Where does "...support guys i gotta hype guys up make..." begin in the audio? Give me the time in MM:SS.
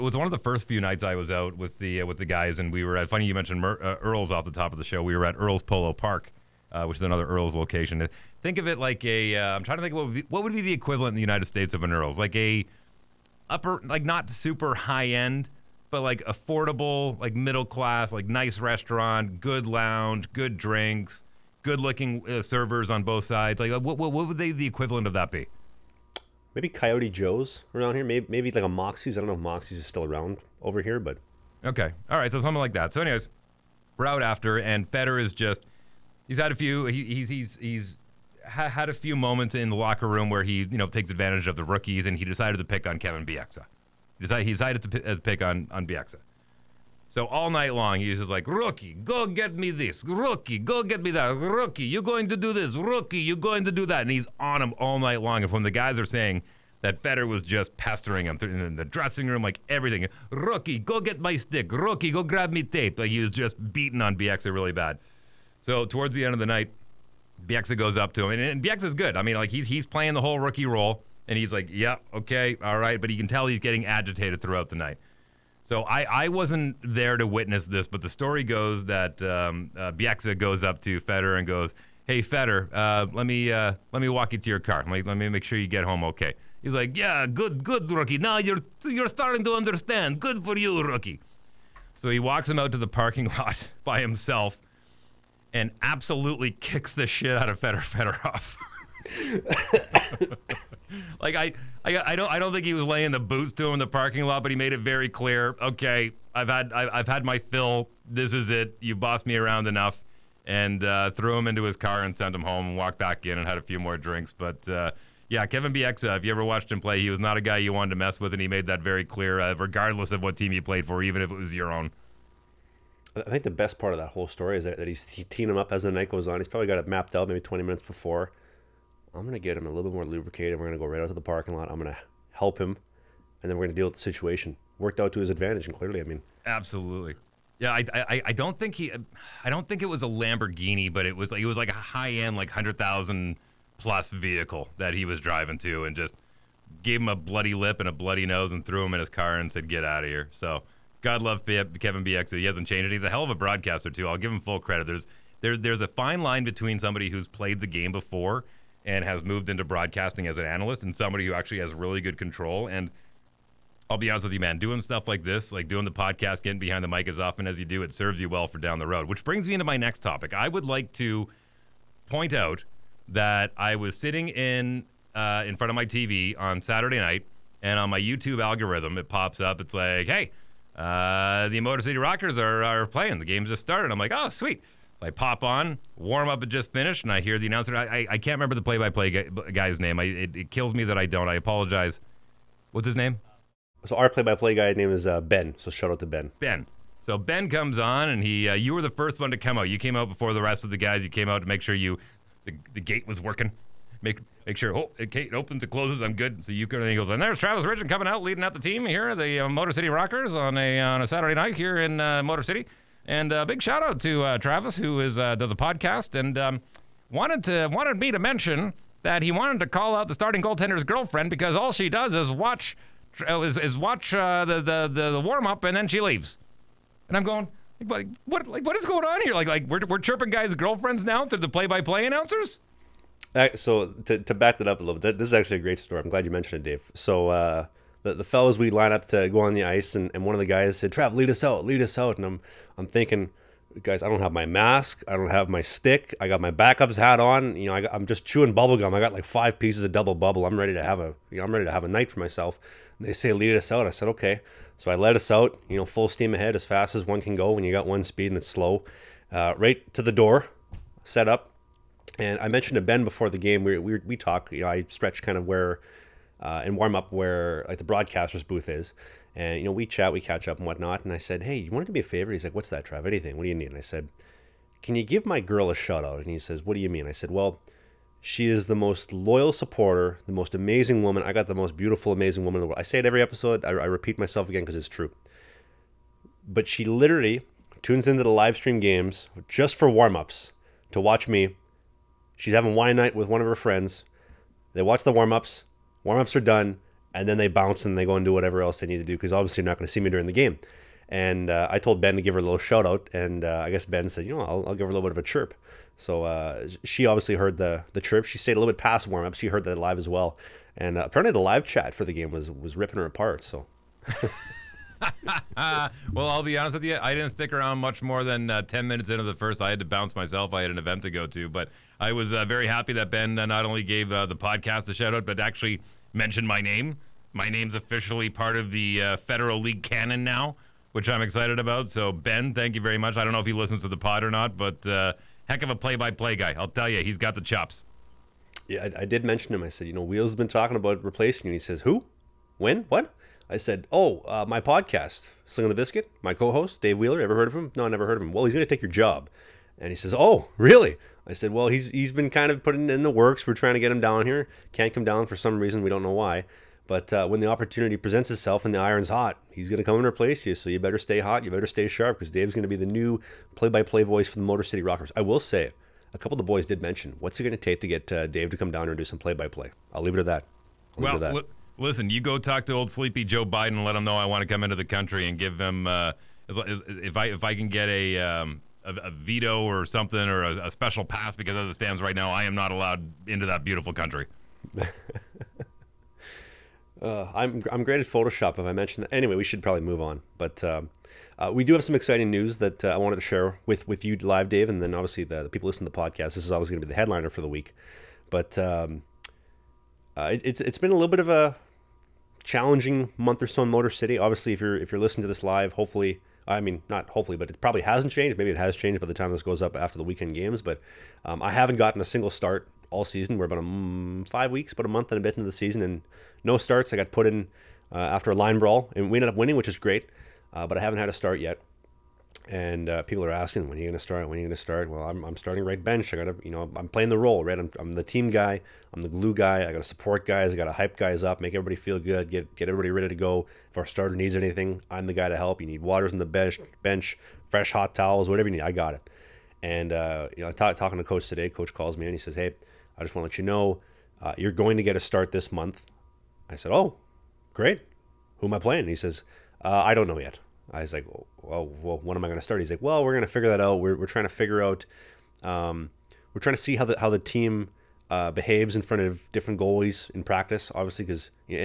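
07:09.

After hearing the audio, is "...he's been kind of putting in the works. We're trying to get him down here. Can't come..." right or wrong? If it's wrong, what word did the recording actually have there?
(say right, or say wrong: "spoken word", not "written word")
right.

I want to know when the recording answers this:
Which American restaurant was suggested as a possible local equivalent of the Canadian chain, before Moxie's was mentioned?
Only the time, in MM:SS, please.
00:26.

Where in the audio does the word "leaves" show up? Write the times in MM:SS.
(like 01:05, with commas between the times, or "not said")
03:45, 06:10.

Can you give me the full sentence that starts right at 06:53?
We're about a, mm, five weeks, but a month and a bit into the season, and no starts.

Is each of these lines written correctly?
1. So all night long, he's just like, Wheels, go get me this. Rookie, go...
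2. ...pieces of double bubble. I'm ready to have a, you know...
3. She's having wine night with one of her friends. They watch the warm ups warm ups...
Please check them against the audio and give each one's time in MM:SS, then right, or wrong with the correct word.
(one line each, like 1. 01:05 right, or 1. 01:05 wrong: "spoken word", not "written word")
1. 00:47 wrong: "Rookie", not "Wheels"
2. 04:09 right
3. 04:52 right.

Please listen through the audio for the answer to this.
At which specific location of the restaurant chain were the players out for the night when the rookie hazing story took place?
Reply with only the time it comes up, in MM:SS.
00:05.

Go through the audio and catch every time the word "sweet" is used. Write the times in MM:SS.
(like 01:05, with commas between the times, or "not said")
03:04.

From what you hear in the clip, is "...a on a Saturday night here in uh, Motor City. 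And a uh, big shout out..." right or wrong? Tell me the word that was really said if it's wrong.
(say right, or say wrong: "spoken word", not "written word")
right.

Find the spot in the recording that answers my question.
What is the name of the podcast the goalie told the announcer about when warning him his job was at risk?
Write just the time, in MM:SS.
05:45.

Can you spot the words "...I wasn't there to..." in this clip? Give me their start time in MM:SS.
01:16.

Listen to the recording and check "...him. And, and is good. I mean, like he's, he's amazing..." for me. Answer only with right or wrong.
wrong.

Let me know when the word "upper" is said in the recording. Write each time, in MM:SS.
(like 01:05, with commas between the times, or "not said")
00:13.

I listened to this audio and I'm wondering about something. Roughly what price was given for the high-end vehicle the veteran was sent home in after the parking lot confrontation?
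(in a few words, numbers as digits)
100,000 plus.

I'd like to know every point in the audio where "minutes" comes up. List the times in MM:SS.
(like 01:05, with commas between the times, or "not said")
02:07, 05:18.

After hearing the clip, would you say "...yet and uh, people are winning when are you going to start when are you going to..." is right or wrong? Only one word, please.
wrong.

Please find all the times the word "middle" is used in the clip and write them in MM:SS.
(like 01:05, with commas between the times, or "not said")
00:17.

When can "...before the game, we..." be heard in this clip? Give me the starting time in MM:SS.
04:23.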